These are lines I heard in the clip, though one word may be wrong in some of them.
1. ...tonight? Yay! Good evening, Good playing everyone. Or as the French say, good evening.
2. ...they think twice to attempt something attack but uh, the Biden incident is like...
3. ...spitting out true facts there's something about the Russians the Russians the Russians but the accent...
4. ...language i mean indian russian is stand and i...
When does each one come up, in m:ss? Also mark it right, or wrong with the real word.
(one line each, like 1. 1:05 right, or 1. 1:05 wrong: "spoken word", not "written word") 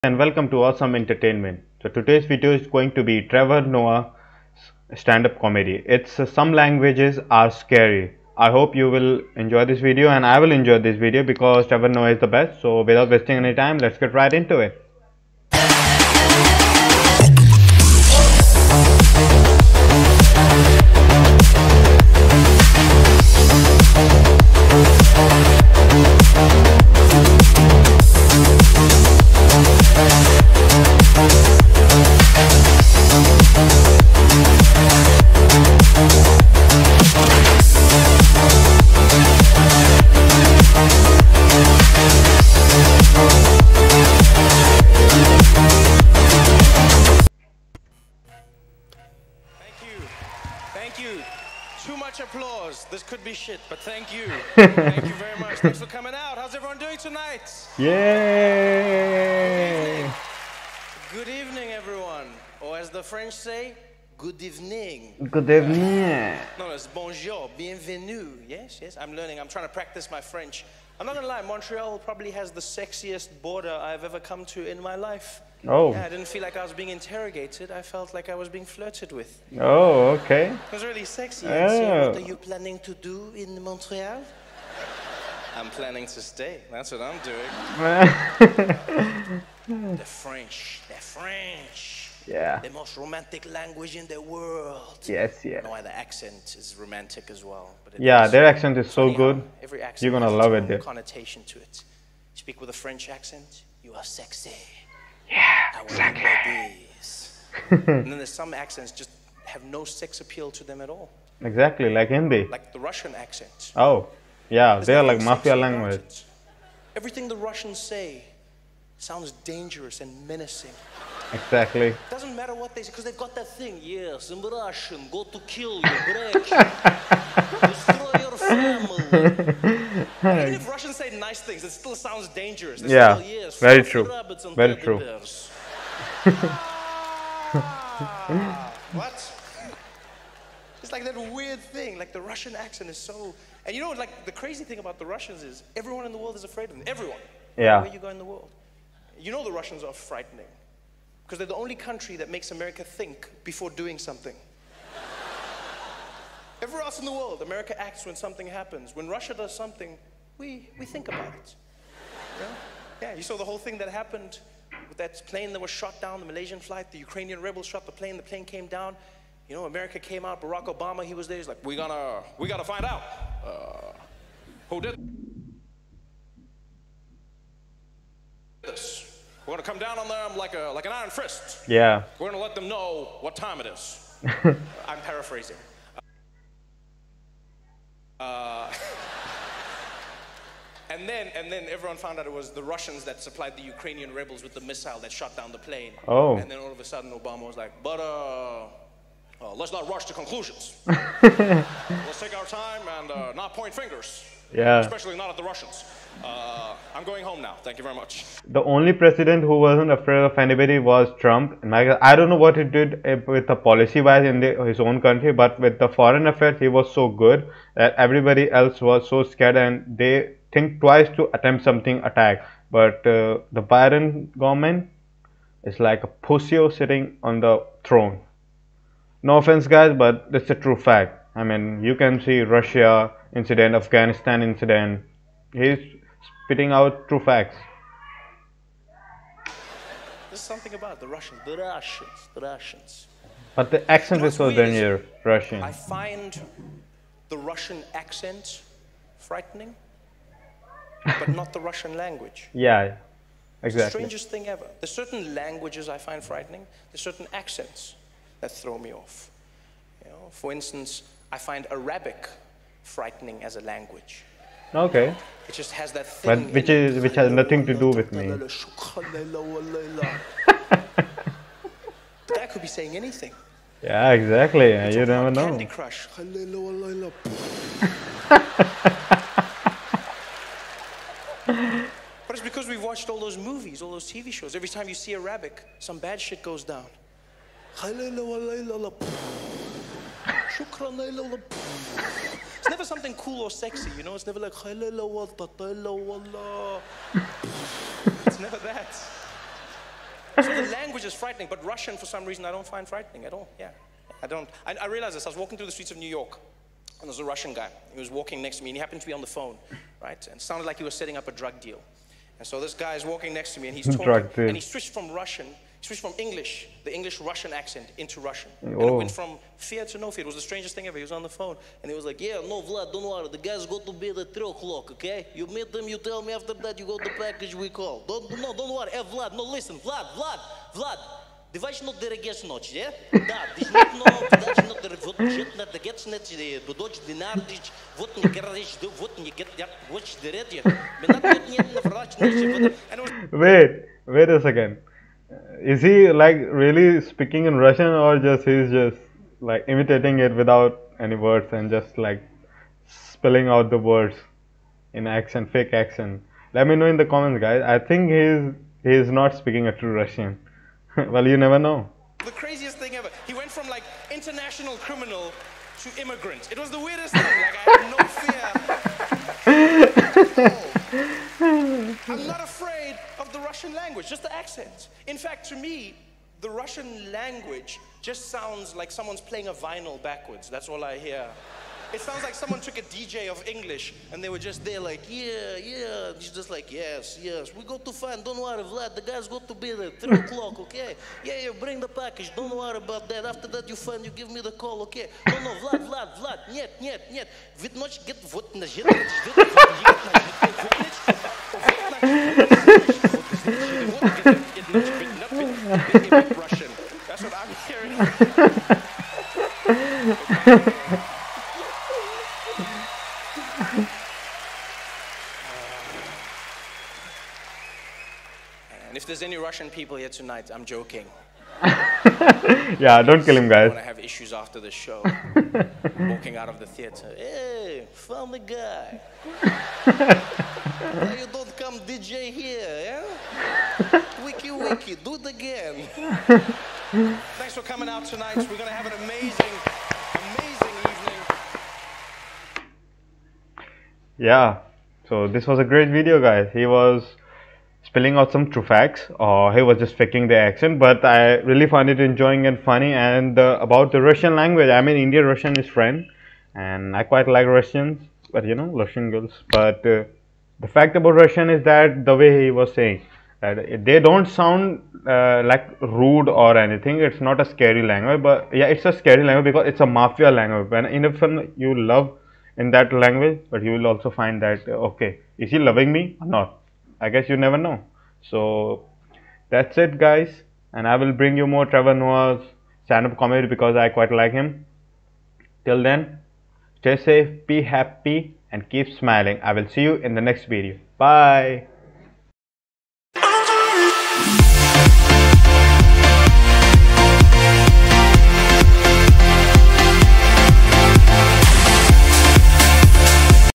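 1. 0:56 wrong: "evening", not "playing"
2. 3:39 wrong: "government", not "incident"
3. 3:56 right
4. 7:34 wrong: "friend", not "stand".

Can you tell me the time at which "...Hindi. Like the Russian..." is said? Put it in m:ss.
1:52.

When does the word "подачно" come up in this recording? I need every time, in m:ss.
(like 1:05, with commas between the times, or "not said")
5:34.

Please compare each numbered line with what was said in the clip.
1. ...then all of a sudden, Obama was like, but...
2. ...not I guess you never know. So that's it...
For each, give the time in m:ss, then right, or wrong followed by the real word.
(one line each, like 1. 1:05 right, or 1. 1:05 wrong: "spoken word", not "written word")
1. 3:16 right
2. 7:56 right.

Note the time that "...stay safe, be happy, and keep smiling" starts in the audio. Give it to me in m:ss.
8:06.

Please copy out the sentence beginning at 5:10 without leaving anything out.
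And sounded like he was setting up a drug deal.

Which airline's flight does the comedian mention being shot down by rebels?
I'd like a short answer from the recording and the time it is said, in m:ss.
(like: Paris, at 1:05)
Malaysian, at 2:46.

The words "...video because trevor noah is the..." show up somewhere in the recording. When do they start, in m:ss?
0:10.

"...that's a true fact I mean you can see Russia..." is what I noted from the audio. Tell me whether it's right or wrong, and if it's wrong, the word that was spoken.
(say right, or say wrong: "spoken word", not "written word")
right.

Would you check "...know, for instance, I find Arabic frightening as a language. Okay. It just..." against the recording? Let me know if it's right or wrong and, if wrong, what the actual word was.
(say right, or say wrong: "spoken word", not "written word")
right.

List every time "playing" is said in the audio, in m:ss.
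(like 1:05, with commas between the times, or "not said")
6:19.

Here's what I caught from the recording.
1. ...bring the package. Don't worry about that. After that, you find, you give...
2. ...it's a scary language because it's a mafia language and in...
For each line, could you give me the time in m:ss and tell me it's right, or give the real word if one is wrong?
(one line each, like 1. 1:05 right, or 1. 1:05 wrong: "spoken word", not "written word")
1. 6:31 right
2. 7:48 right.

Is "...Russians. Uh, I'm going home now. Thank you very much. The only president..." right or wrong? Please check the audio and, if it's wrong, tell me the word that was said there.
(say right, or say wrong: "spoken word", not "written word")
right.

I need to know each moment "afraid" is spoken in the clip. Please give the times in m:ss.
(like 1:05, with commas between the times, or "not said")
2:26, 3:29, 6:12.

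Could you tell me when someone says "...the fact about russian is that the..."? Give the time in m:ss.
7:40.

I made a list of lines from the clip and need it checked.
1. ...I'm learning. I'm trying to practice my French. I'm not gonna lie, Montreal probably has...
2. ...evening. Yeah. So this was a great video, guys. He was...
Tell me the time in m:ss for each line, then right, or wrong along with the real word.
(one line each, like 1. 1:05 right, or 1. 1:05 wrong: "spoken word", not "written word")
1. 1:09 right
2. 7:22 right.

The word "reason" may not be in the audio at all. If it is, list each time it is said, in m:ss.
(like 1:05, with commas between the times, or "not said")
5:02.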